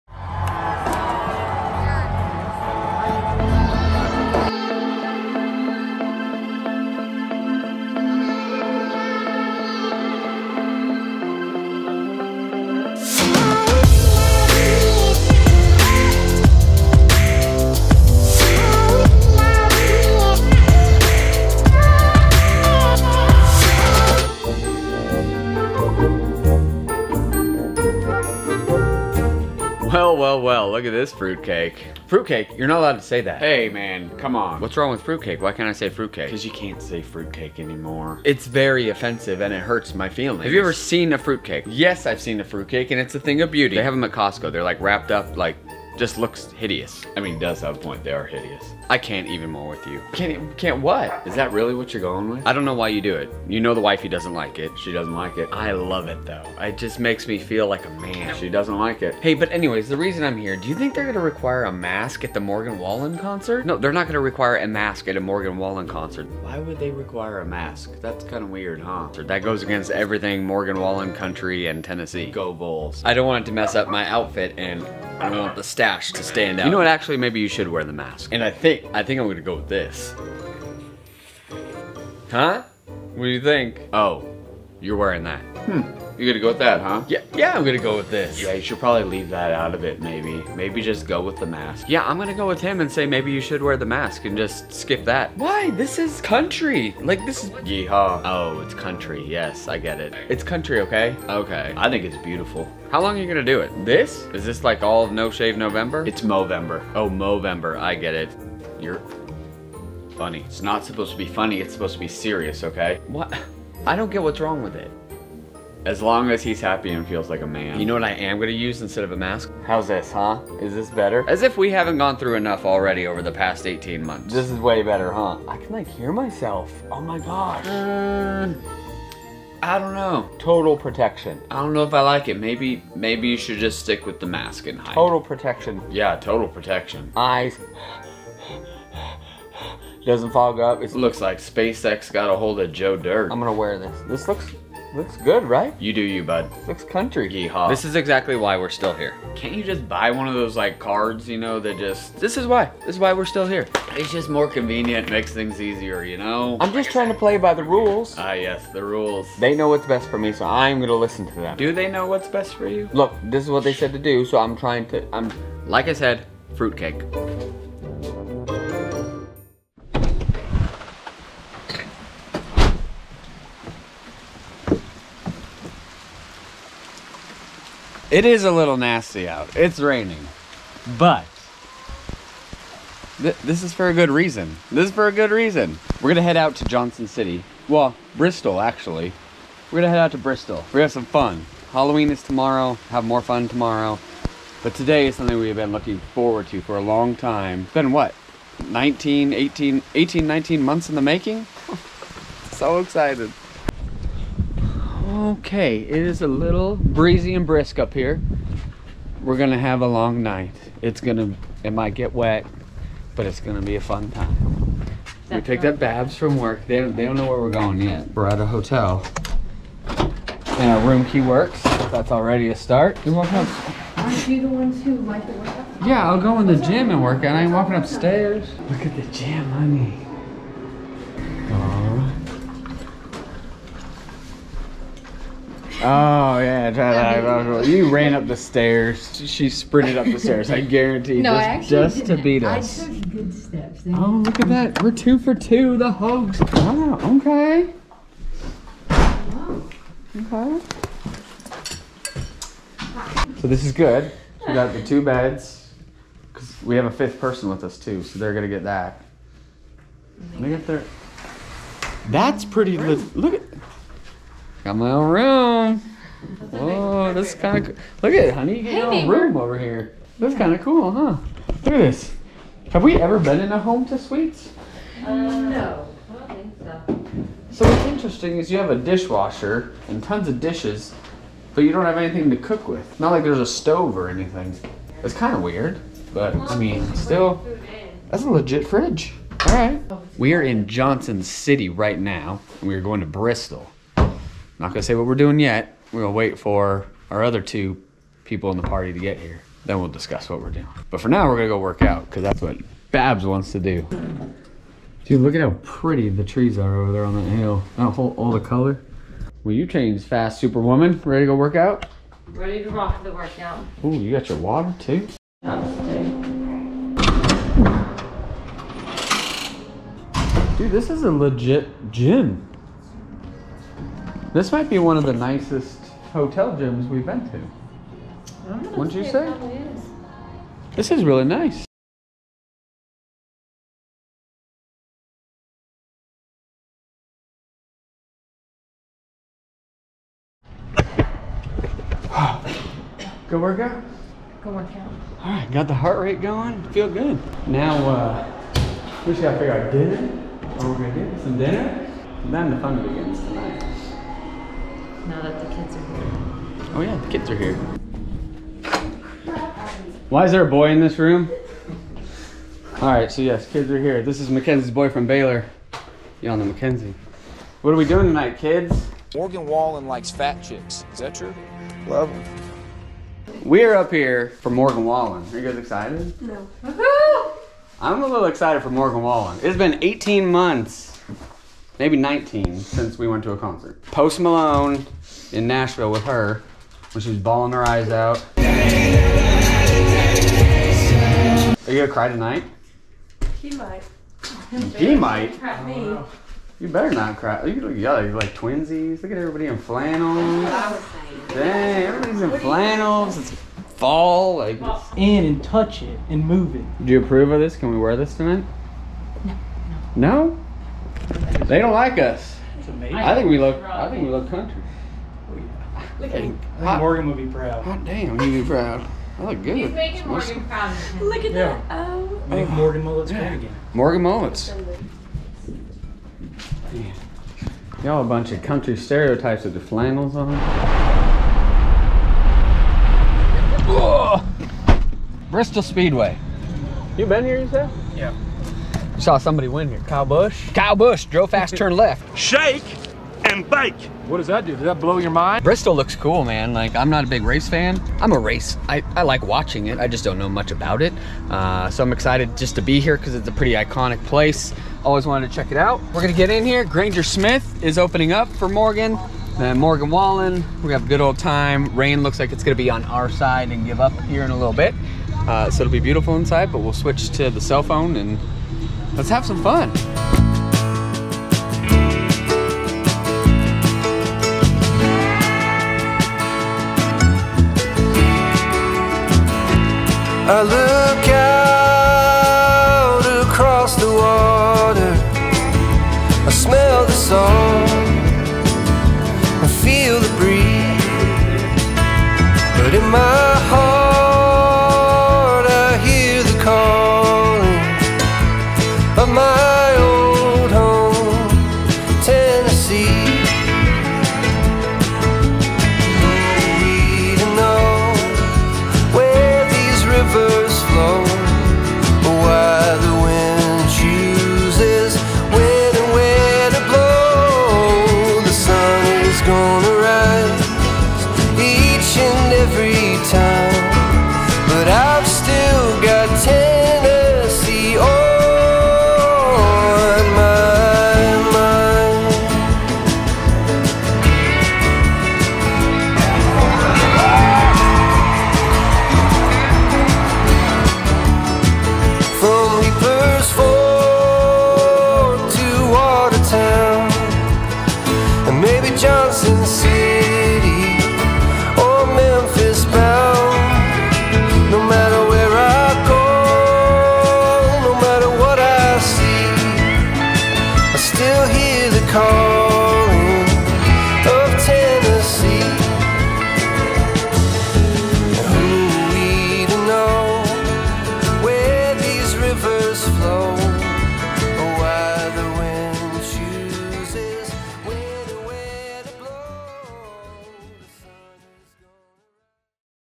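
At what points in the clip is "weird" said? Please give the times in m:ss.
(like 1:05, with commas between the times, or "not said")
1:08, 4:45.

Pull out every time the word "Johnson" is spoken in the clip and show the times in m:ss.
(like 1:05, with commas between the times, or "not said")
3:06, 4:50.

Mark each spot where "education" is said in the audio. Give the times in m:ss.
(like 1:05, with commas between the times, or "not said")
not said.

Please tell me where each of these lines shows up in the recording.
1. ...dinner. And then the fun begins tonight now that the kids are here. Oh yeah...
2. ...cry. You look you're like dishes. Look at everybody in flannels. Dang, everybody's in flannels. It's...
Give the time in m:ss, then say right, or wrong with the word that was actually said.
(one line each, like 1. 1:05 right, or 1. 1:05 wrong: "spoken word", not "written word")
1. 5:51 right
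2. 6:37 wrong: "twinsies", not "dishes".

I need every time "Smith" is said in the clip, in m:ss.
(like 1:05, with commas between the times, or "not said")
7:37.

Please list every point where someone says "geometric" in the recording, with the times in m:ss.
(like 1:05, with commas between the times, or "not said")
not said.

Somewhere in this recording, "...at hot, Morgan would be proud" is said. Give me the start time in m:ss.
6:56.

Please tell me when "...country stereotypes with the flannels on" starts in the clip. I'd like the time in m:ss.
7:08.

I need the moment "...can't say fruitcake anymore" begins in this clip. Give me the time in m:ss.
0:36.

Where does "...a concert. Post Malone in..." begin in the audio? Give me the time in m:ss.
6:23.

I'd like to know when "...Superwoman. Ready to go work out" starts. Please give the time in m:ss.
5:10.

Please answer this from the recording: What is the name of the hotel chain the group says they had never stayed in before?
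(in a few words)
Home2 Suites.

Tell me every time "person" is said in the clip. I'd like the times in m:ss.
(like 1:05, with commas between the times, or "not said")
4:17.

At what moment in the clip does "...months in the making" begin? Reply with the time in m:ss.
3:20.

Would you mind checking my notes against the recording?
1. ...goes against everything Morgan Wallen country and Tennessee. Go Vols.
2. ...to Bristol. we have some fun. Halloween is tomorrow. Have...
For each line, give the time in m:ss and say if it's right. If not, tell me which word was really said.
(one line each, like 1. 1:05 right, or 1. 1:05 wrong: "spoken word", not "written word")
1. 1:09 right
2. 3:10 right.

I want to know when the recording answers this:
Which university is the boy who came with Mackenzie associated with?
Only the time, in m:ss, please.
6:05.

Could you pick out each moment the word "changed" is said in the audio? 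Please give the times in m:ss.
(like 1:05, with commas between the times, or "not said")
5:09.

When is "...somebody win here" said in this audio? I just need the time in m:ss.
7:19.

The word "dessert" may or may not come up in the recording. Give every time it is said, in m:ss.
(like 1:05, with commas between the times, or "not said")
not said.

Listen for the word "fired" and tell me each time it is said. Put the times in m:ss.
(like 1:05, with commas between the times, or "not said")
not said.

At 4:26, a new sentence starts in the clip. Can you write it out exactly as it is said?
Whoa, this is kind of cool.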